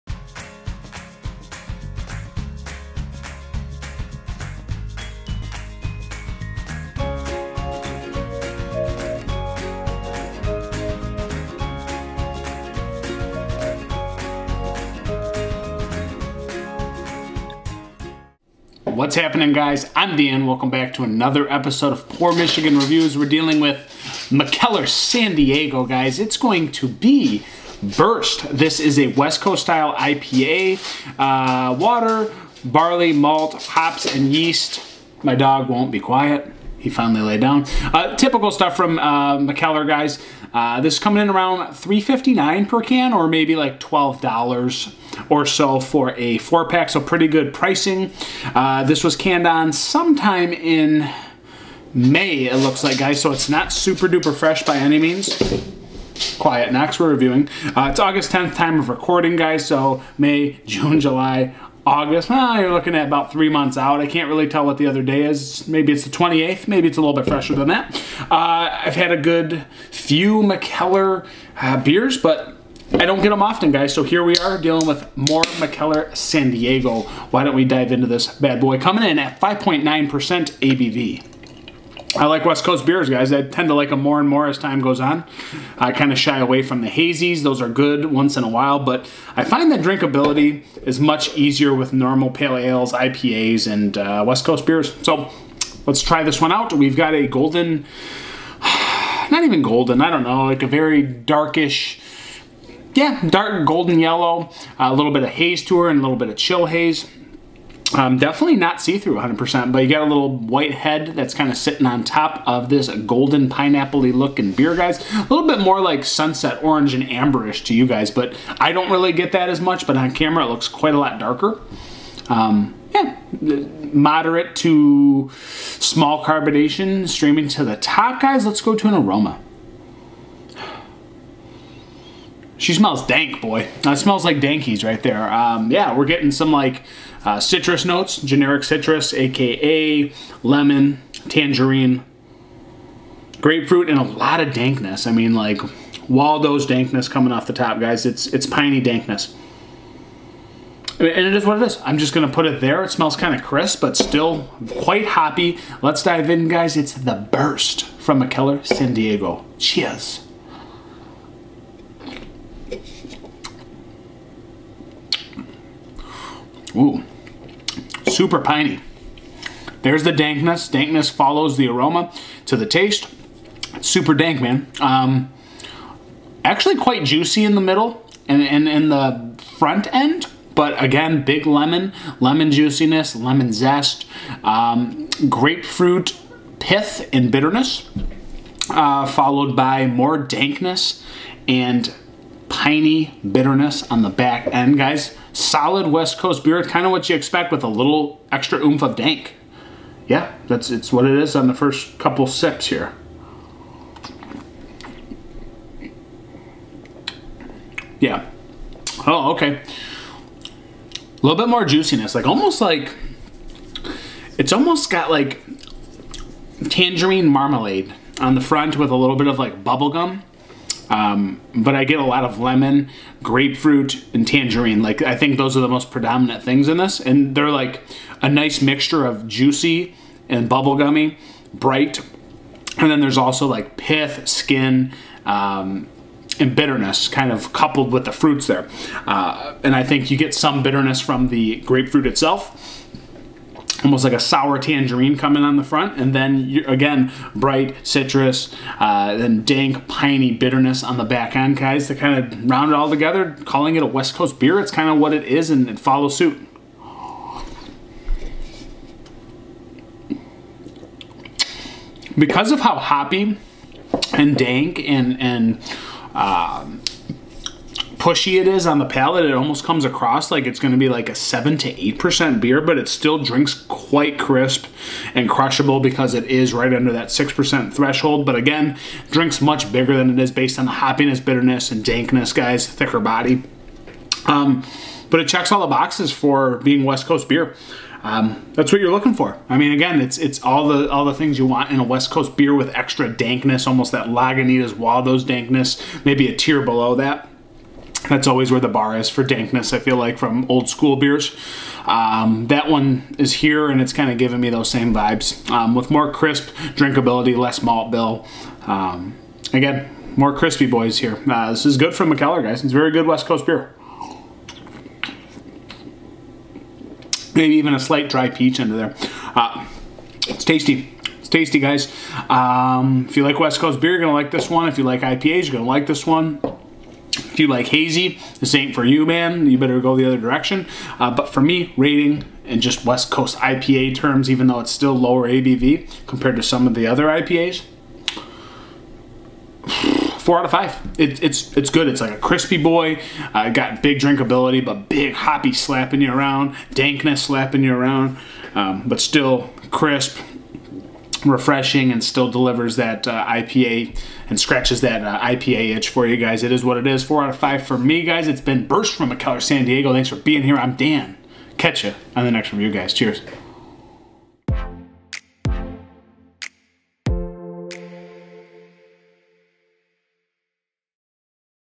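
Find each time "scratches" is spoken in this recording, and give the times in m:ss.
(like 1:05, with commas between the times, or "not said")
5:54.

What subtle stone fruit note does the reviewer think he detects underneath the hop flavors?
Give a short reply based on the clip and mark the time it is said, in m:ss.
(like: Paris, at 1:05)
dry peach, at 5:18.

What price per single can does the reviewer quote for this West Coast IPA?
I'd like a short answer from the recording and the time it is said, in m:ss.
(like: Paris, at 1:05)
$3.59, at 0:41.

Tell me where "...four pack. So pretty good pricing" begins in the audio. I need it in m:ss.
0:46.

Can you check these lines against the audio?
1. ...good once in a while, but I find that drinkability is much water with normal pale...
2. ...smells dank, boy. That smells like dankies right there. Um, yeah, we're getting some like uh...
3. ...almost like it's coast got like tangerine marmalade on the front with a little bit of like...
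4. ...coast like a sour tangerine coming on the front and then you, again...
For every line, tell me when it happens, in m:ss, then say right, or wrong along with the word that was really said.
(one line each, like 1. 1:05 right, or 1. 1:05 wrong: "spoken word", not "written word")
1. 1:27 wrong: "easier", not "water"
2. 2:12 right
3. 3:32 wrong: "almost", not "coast"
4. 4:03 wrong: "almost", not "coast".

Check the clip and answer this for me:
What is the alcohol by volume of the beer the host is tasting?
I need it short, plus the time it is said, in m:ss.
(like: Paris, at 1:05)
5.9%, at 1:19.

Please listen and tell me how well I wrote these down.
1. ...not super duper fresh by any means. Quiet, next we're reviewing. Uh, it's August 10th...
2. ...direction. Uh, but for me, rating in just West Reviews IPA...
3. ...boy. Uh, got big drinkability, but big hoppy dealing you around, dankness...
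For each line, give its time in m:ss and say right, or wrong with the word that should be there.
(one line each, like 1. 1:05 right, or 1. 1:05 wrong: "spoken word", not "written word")
1. 0:53 right
2. 5:30 wrong: "Coast", not "Reviews"
3. 5:42 wrong: "slapping", not "dealing".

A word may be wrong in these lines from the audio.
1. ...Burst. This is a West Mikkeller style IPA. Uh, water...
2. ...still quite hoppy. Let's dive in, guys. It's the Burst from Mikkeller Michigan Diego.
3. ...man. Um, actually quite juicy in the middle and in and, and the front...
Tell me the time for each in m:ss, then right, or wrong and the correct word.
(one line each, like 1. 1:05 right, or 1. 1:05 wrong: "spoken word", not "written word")
1. 0:27 wrong: "Coast", not "Mikkeller"
2. 2:33 wrong: "San", not "Michigan"
3. 2:54 right.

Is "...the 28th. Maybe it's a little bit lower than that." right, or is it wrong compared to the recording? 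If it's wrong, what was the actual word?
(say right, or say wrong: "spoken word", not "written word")
wrong: "fresher", not "lower".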